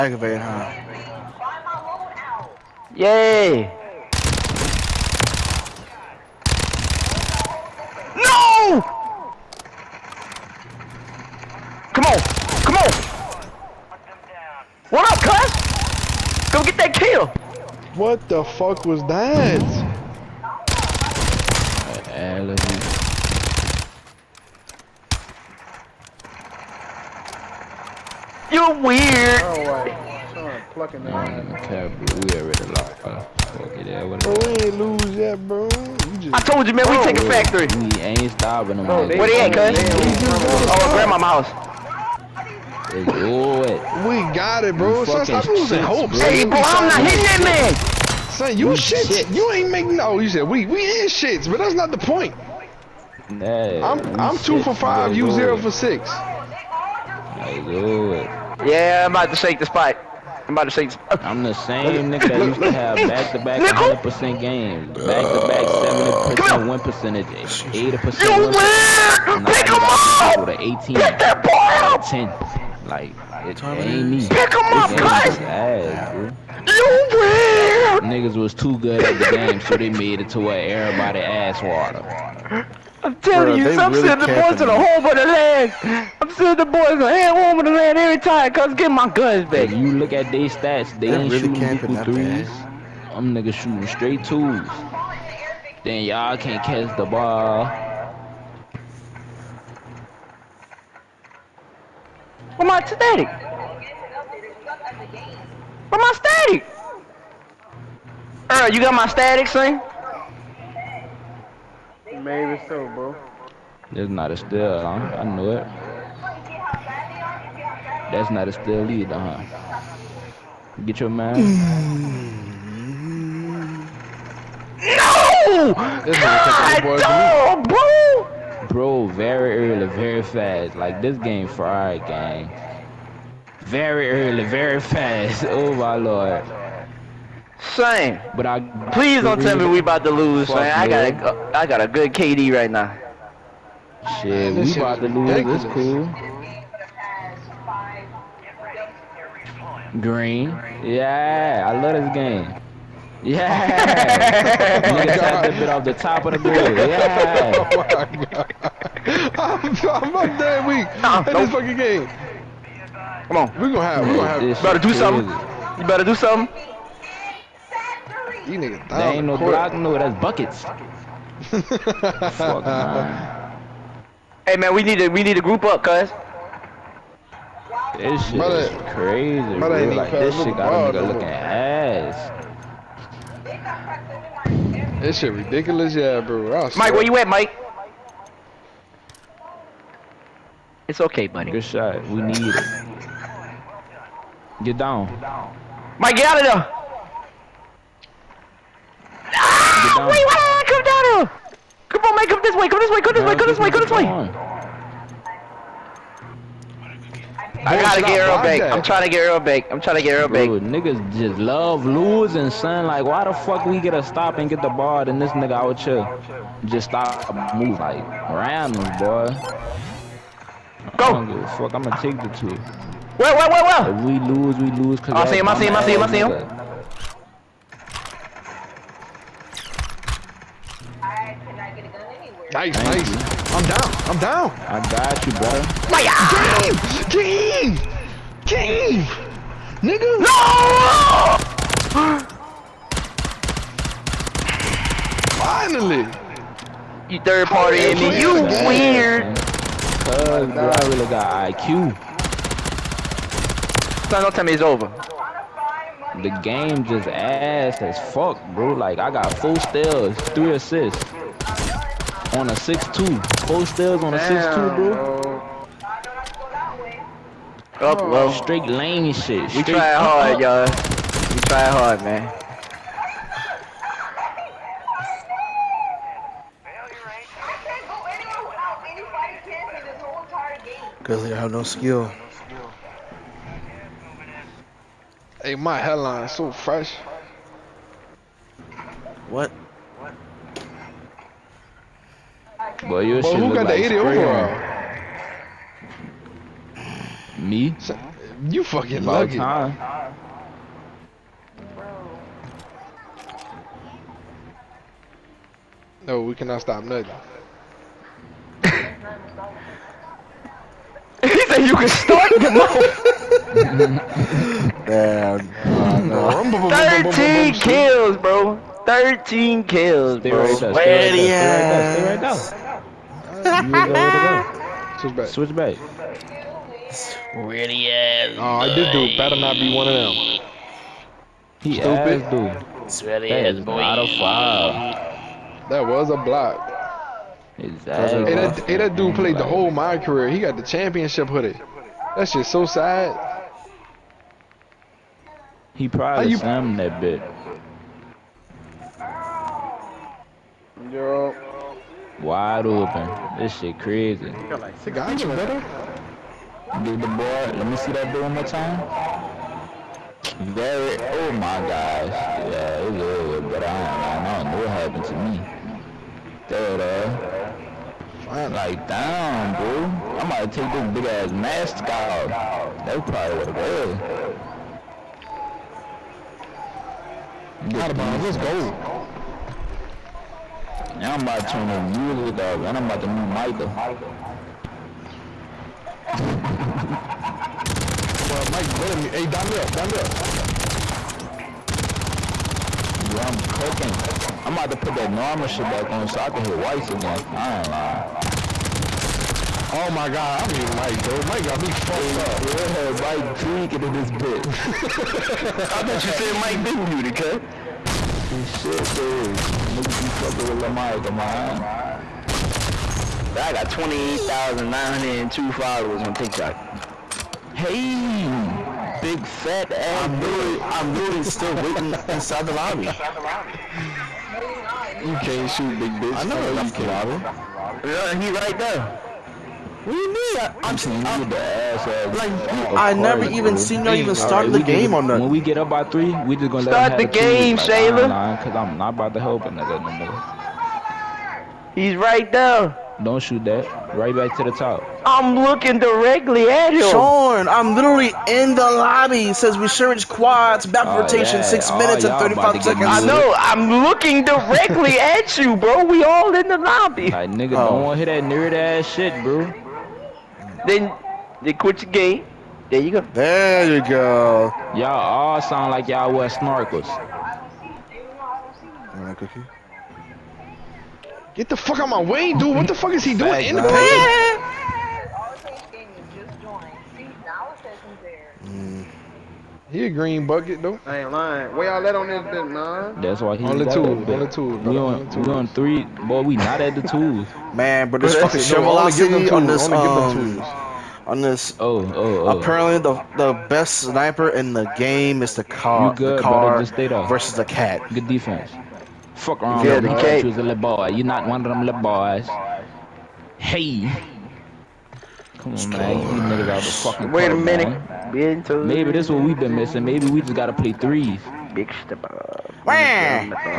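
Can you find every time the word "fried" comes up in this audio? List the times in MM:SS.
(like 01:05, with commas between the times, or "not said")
02:11.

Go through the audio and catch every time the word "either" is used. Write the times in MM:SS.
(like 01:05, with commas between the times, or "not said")
01:58.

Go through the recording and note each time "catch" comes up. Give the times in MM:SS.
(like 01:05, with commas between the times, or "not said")
01:36.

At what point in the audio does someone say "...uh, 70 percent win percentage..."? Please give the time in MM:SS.
01:05.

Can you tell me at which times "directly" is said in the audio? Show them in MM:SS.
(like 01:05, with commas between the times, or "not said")
07:25, 07:34.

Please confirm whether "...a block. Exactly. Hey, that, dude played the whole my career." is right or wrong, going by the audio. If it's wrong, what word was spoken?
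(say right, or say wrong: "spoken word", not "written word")
right.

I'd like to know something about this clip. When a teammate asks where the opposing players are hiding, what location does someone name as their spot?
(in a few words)
Grandma's house.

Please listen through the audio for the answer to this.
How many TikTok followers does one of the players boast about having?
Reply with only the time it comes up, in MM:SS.
06:53.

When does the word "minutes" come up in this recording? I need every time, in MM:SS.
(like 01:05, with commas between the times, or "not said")
07:31, 08:27.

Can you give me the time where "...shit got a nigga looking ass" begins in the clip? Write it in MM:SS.
03:00.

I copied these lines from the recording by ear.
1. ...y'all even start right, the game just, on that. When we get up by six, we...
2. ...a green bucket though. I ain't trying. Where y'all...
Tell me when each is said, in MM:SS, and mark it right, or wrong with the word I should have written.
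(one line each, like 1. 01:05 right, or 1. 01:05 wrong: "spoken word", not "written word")
1. 07:13 wrong: "three", not "six"
2. 07:59 wrong: "lying", not "trying".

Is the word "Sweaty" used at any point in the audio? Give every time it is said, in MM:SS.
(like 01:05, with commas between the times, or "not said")
05:32.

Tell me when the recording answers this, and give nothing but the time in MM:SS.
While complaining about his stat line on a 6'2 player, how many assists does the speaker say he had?
04:20.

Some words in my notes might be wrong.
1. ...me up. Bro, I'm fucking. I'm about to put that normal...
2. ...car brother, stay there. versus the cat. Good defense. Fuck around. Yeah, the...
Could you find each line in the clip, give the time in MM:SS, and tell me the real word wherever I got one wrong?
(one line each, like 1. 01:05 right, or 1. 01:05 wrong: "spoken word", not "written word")
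1. 06:29 wrong: "cooking", not "fucking"
2. 08:16 right.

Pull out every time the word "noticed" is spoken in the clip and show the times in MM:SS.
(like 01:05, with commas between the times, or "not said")
not said.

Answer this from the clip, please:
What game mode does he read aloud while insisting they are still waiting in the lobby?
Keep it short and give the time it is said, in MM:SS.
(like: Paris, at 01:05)
Resurgence quads, at 07:29.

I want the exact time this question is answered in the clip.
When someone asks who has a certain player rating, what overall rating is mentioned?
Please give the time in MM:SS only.
04:53.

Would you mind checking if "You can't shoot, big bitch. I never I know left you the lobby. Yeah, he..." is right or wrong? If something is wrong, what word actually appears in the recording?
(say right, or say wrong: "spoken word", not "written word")
right.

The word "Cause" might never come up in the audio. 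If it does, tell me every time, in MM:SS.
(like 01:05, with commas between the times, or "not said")
03:44, 04:10, 04:41, 07:18, 08:32.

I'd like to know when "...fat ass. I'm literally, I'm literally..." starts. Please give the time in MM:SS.
06:59.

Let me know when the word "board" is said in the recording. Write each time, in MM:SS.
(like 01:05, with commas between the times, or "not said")
02:36, 05:57.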